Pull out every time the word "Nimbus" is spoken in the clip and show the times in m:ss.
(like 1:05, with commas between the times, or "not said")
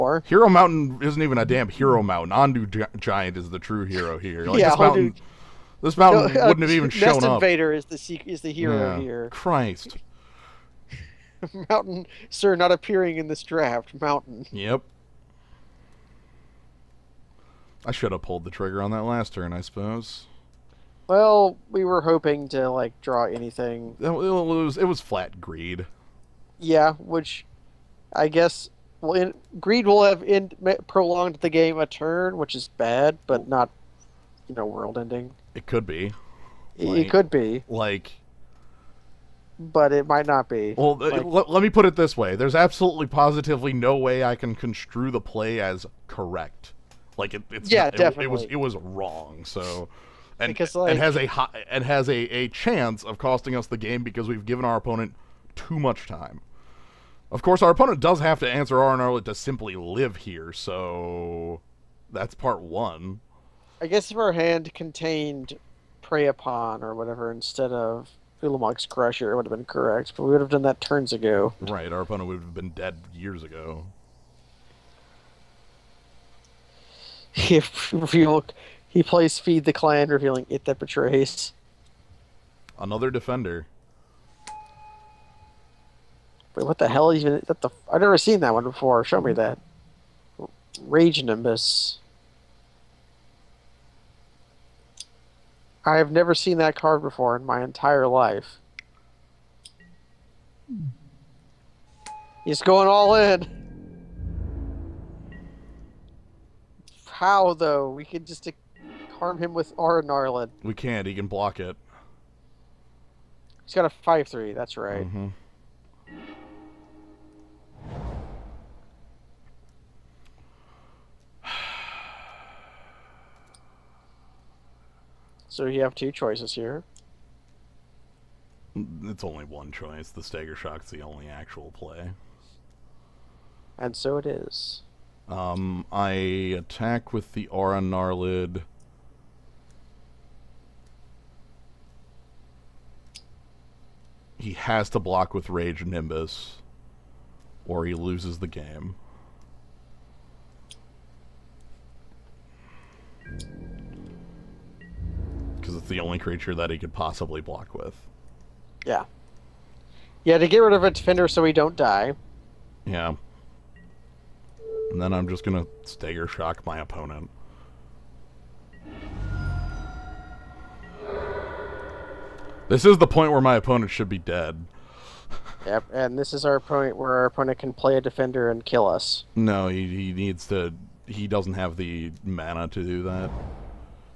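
1:31, 2:25.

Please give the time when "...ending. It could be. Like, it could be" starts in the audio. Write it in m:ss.
0:34.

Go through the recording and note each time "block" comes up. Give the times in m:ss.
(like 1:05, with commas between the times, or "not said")
1:51, 2:25, 2:37.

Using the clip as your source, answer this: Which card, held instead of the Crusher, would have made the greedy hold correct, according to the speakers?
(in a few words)
Prey Upon.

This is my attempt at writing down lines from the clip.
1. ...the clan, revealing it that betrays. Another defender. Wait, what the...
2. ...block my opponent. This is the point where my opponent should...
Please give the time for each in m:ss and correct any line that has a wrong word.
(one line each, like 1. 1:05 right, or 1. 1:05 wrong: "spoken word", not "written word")
1. 1:19 right
2. 2:46 wrong: "shock", not "block".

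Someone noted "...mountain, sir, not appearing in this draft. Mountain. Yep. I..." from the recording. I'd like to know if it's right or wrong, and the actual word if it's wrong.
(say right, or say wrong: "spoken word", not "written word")
right.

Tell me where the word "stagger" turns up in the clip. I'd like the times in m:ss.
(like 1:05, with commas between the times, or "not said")
2:10, 2:45.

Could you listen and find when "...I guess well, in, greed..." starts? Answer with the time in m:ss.
0:28.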